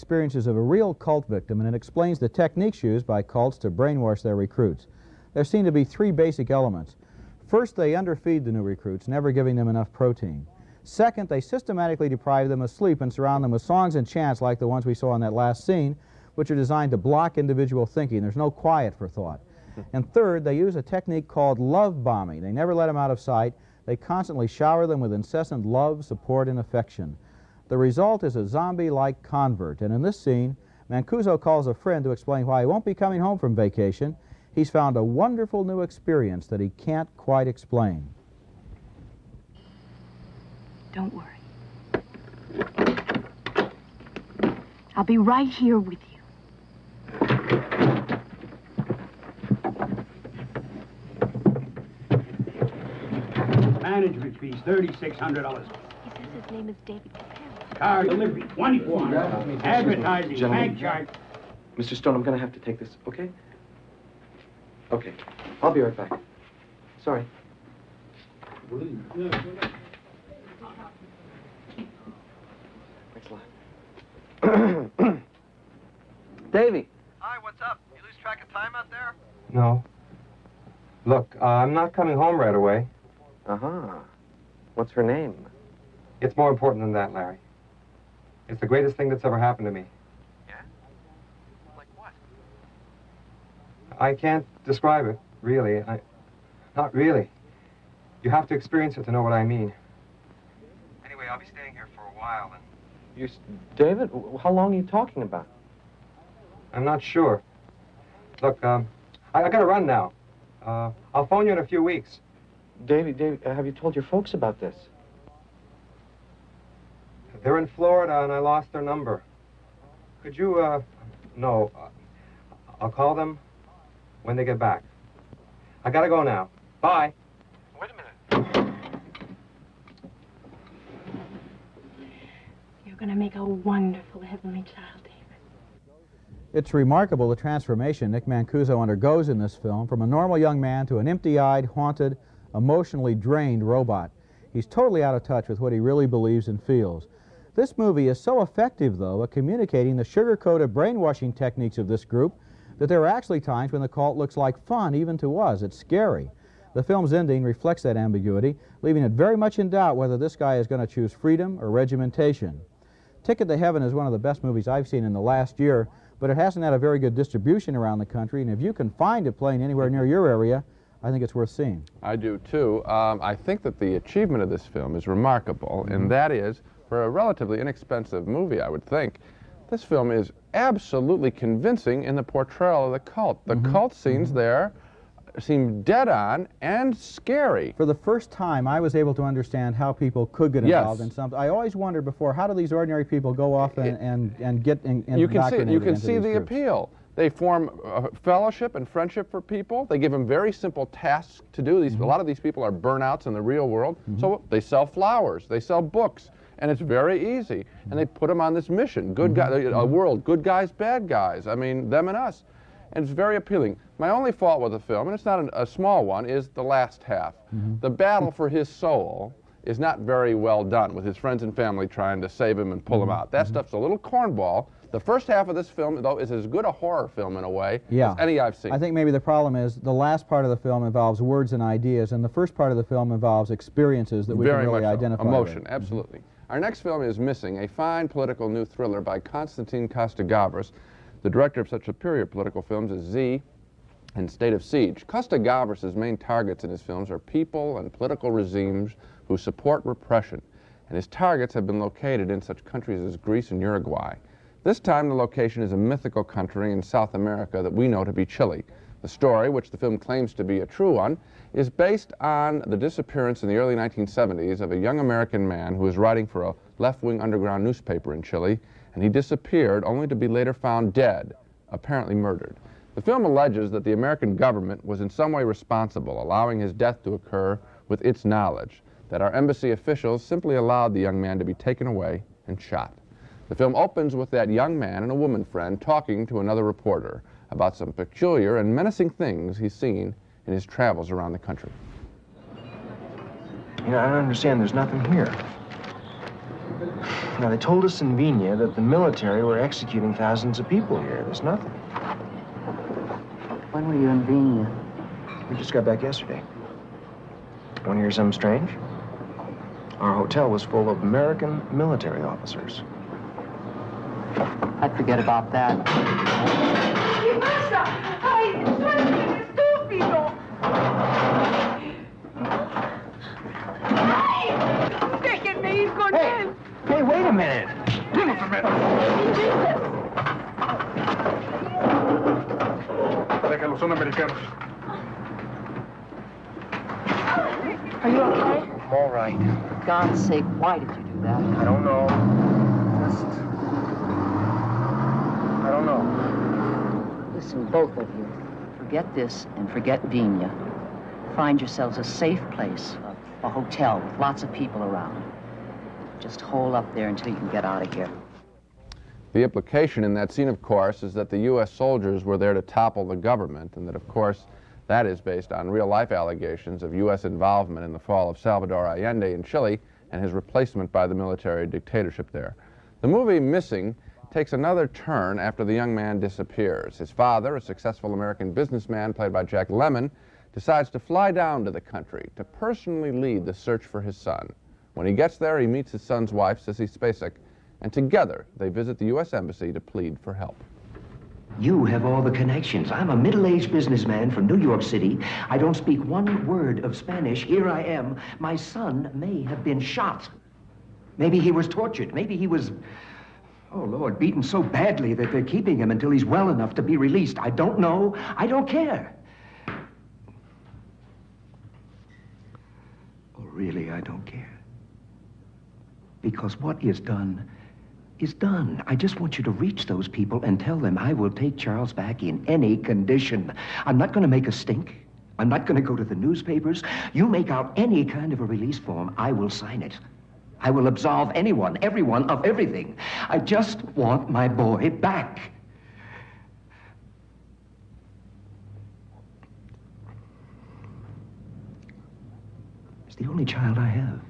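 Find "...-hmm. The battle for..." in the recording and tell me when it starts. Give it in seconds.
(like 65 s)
217 s.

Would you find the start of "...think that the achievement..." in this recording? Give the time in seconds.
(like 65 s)
173 s.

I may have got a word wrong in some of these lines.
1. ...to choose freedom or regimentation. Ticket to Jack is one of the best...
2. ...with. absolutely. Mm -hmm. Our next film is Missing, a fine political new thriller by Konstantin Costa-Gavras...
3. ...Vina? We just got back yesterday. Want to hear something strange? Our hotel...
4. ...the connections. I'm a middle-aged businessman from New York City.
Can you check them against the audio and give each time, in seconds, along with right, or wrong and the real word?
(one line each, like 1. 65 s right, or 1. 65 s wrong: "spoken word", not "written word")
1. 160 s wrong: "Heaven", not "Jack"
2. 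235 s right
3. 304 s right
4. 392 s right.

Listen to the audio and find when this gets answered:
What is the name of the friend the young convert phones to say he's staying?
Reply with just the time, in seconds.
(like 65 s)
87 s.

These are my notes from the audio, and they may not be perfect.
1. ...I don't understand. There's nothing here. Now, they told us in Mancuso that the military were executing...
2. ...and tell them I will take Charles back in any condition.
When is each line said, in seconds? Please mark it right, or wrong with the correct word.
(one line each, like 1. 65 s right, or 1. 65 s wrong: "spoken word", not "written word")
1. 293 s wrong: "Vina", not "Mancuso"
2. 420 s right.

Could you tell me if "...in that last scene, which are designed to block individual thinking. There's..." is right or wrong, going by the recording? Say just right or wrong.
right.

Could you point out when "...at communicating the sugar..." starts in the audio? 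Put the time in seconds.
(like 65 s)
149 s.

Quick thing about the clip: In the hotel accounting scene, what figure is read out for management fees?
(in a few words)
$3,600.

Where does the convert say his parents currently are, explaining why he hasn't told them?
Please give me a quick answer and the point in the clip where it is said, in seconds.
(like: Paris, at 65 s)
Florida, at 117 s.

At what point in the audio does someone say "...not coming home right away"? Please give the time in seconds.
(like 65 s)
81 s.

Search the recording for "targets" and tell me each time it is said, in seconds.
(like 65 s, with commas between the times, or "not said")
246 s, 251 s.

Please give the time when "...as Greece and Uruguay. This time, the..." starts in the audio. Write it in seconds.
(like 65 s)
253 s.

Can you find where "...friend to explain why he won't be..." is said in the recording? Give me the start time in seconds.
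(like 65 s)
31 s.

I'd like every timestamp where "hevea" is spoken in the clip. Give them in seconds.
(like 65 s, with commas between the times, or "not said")
not said.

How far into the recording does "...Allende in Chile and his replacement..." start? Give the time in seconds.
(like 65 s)
368 s.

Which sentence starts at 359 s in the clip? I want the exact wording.
The implication in that scene, of course, is that the U.S.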